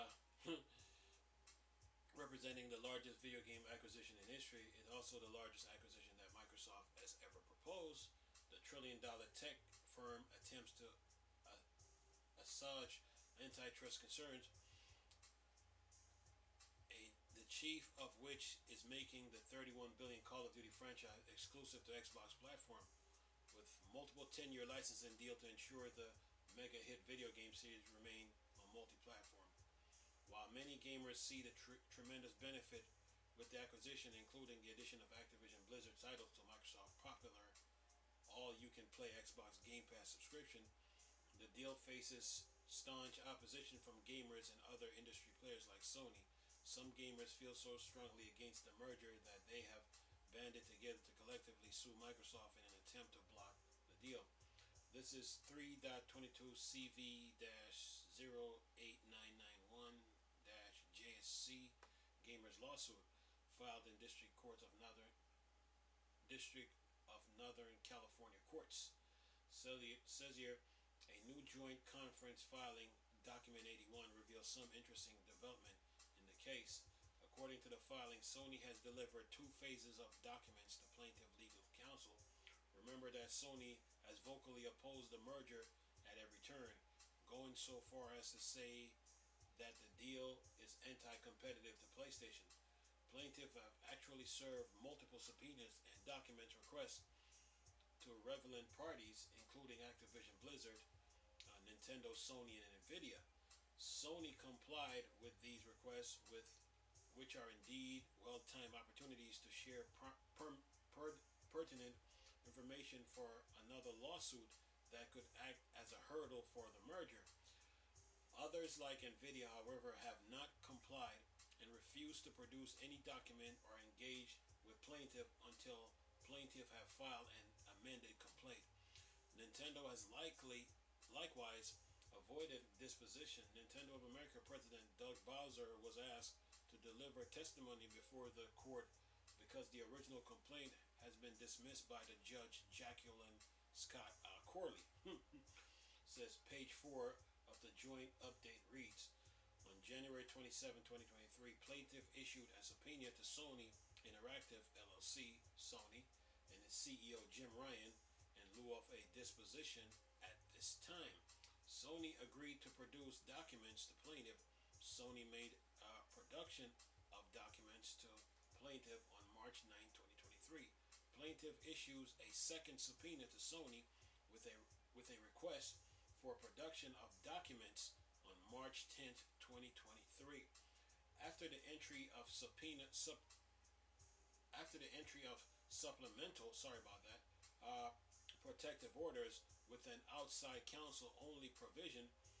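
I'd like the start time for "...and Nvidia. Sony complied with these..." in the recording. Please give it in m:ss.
1:42.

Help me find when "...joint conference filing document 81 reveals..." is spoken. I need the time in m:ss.
1:11.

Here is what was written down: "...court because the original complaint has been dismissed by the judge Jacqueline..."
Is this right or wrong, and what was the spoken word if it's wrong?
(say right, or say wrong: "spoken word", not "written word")
right.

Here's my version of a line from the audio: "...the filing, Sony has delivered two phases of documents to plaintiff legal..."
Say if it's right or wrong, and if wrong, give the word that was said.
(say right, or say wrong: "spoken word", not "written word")
right.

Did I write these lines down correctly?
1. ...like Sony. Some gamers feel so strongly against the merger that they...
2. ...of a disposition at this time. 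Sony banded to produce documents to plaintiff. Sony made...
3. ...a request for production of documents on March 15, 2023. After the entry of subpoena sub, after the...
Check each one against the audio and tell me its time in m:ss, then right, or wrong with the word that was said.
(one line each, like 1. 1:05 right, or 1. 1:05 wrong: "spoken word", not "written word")
1. 0:45 right
2. 2:38 wrong: "agreed", not "banded"
3. 2:55 wrong: "10", not "15".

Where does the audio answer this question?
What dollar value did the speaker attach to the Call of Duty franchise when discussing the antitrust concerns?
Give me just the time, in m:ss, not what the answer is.
0:19.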